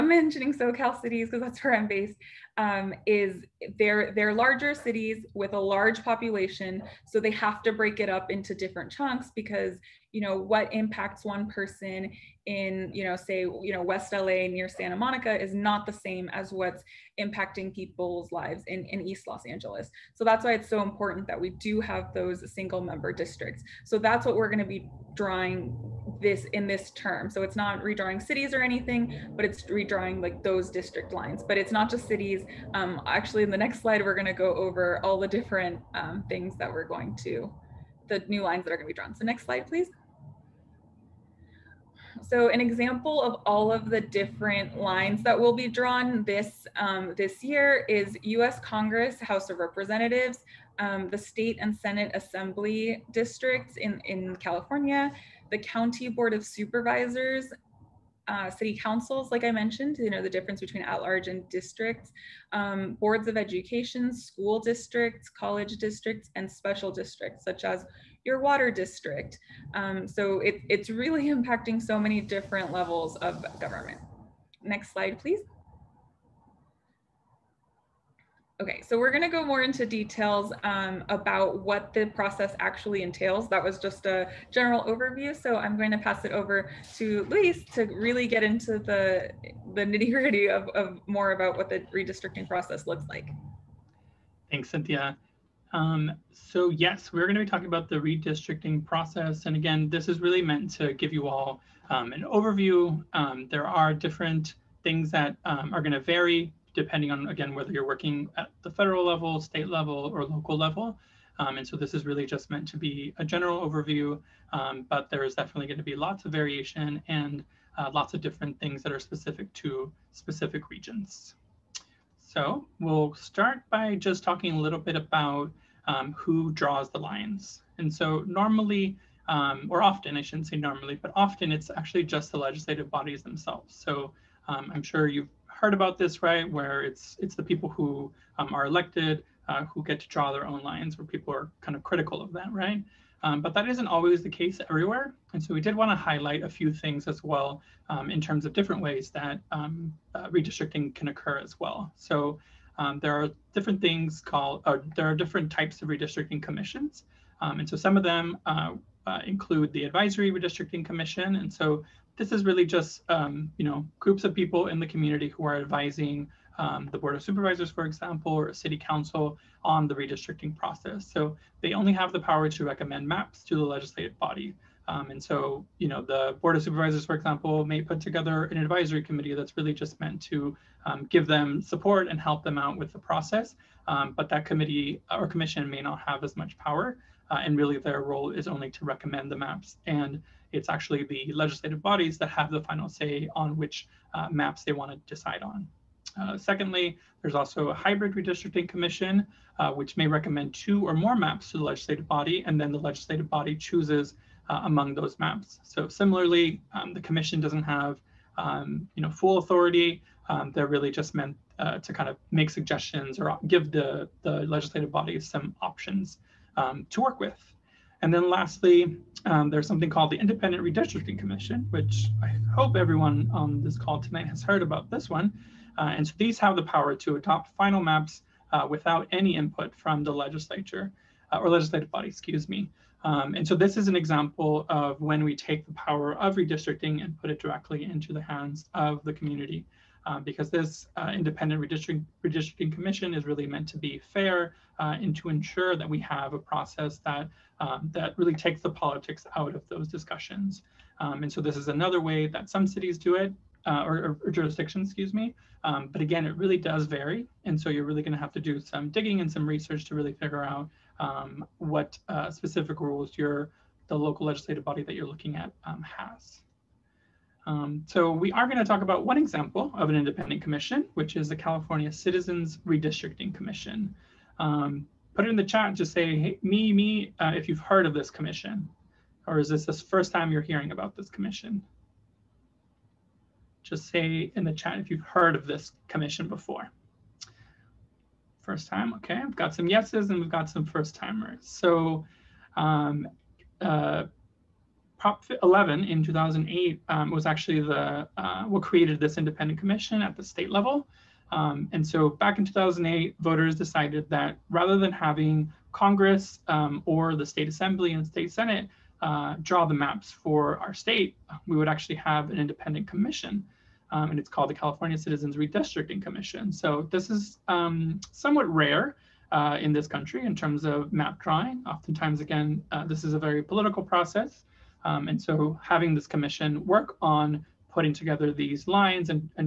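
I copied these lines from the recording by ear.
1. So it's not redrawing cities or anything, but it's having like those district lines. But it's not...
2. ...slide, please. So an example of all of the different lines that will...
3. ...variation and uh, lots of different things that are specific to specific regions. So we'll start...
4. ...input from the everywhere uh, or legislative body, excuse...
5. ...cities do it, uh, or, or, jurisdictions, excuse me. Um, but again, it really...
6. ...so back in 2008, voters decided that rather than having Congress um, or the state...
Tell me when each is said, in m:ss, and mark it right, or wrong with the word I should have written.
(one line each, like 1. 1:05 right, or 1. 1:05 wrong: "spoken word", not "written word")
1. 0:27 wrong: "redrawing", not "having"
2. 0:39 right
3. 1:56 right
4. 3:49 wrong: "legislature", not "everywhere"
5. 4:12 right
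6. 5:01 right.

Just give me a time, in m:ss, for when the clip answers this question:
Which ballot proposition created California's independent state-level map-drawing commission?
4:55.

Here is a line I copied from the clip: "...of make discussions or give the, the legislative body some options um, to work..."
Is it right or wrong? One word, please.
wrong.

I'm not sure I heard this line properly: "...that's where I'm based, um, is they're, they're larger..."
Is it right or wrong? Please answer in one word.
right.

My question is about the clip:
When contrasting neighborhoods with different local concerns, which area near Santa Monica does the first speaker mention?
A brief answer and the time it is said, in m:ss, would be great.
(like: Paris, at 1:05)
West LA, at 0:13.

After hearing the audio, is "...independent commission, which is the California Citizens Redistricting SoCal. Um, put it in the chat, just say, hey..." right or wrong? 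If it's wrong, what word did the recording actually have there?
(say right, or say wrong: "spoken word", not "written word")
wrong: "Commission", not "SoCal".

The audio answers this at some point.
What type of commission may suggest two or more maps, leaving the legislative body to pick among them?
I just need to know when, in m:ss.
3:17.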